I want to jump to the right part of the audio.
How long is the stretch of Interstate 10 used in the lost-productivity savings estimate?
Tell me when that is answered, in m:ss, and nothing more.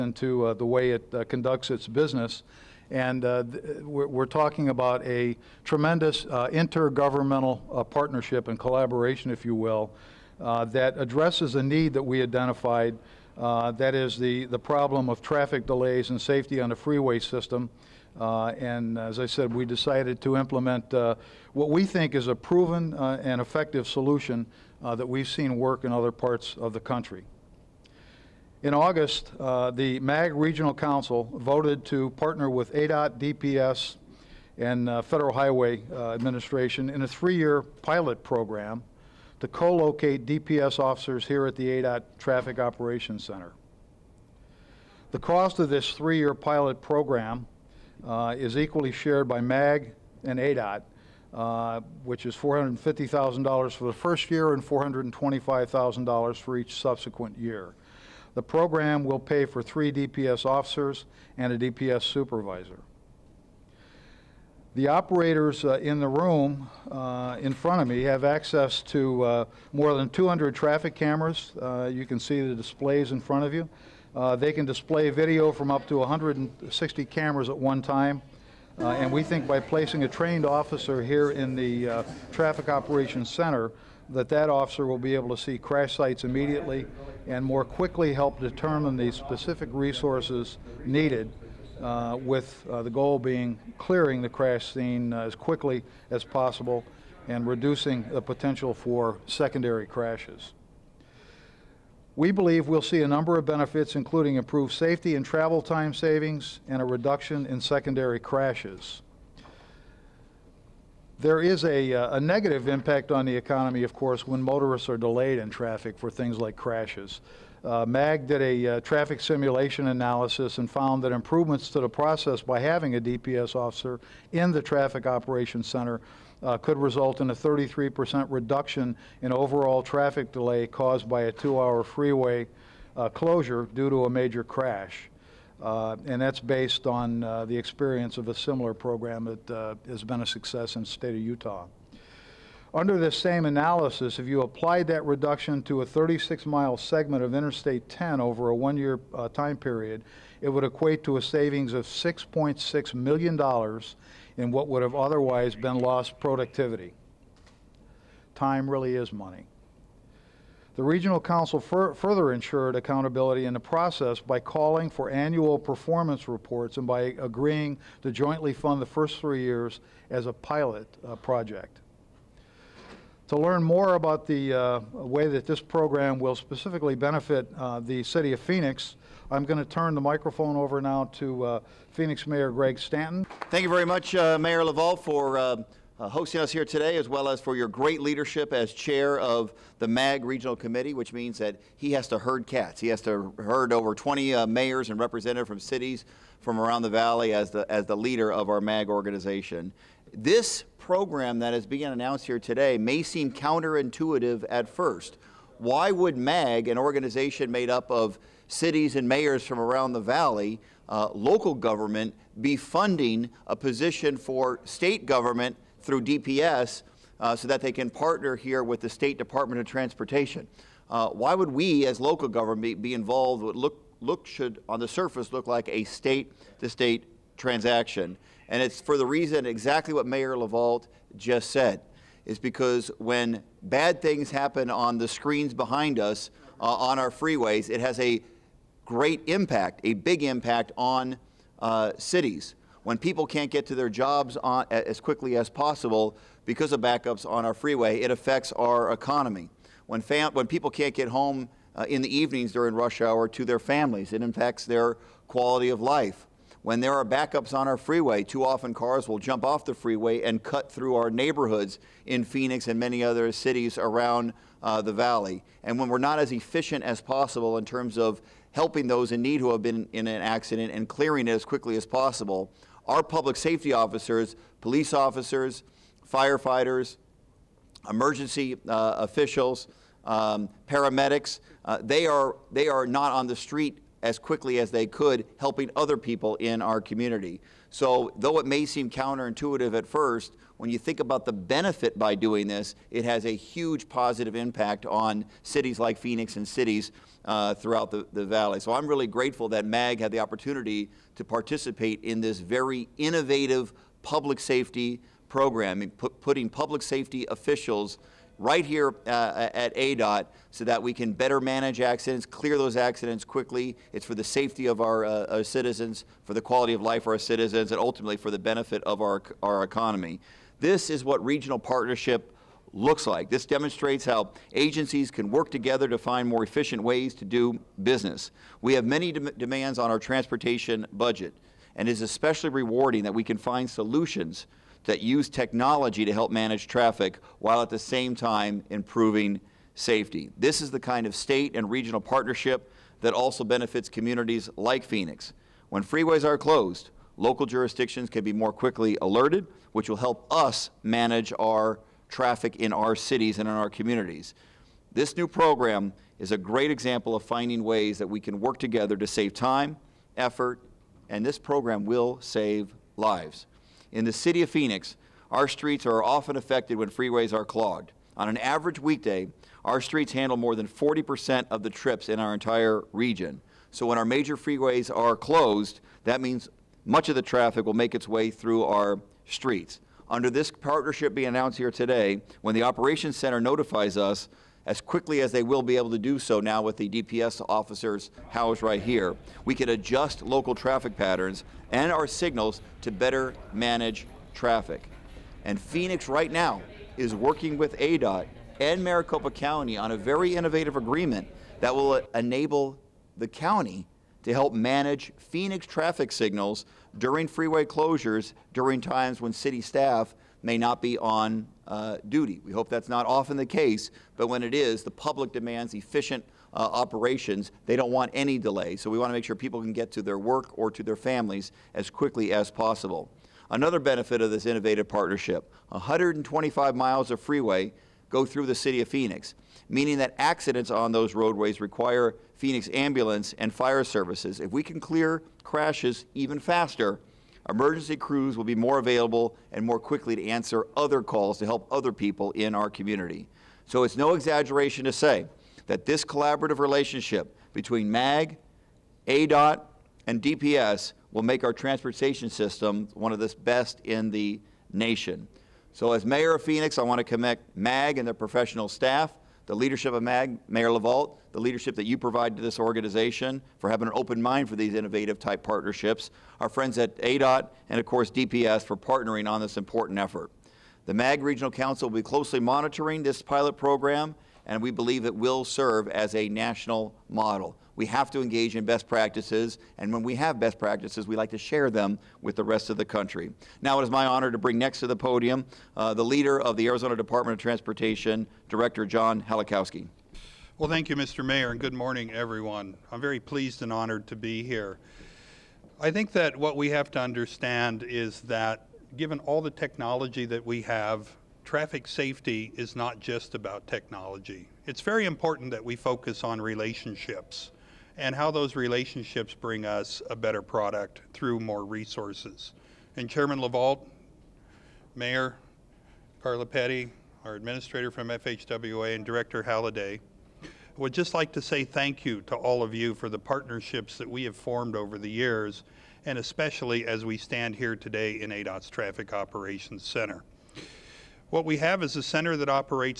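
2:25.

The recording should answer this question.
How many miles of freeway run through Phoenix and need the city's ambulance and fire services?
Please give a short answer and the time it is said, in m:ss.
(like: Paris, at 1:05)
125, at 7:05.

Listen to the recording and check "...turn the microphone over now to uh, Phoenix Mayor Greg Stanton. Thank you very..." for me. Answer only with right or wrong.
right.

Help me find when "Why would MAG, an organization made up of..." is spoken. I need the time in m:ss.
3:25.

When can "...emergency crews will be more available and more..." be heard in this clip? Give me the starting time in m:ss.
7:17.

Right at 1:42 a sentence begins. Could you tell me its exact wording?
We believe we'll see a number of benefits, including improved safety and travel time savings and a reduction in secondary crashes.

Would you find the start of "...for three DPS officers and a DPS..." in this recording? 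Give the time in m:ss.
0:59.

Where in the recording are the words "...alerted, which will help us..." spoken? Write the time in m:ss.
5:49.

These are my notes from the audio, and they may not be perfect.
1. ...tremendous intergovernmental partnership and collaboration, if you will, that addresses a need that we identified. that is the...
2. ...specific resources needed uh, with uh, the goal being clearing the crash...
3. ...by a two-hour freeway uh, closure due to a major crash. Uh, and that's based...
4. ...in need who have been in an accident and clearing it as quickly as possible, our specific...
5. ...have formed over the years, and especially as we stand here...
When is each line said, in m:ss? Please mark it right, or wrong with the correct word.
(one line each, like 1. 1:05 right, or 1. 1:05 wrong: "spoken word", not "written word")
1. 0:05 right
2. 1:29 right
3. 2:11 right
4. 4:29 wrong: "public", not "specific"
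5. 8:44 right.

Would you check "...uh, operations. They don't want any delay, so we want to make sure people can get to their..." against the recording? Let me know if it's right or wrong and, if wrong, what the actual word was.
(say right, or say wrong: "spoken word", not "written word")
right.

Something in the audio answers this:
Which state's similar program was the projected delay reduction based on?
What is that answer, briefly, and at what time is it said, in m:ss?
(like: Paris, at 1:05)
Utah, at 2:21.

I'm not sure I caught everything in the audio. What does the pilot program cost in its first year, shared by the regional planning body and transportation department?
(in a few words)
$450,000.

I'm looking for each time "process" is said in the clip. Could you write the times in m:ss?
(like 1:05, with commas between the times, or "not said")
2:01, 2:43.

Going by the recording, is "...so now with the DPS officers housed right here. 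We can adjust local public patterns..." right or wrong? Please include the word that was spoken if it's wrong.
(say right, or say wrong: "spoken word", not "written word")
wrong: "traffic", not "public".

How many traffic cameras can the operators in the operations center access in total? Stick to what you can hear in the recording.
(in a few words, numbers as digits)
more than 200.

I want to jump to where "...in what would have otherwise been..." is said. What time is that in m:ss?
2:34.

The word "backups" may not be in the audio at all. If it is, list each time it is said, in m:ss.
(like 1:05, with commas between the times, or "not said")
4:06, 4:17.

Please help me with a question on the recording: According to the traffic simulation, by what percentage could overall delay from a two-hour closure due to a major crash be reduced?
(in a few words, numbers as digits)
33%.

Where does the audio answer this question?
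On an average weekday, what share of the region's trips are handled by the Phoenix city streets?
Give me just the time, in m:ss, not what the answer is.
6:10.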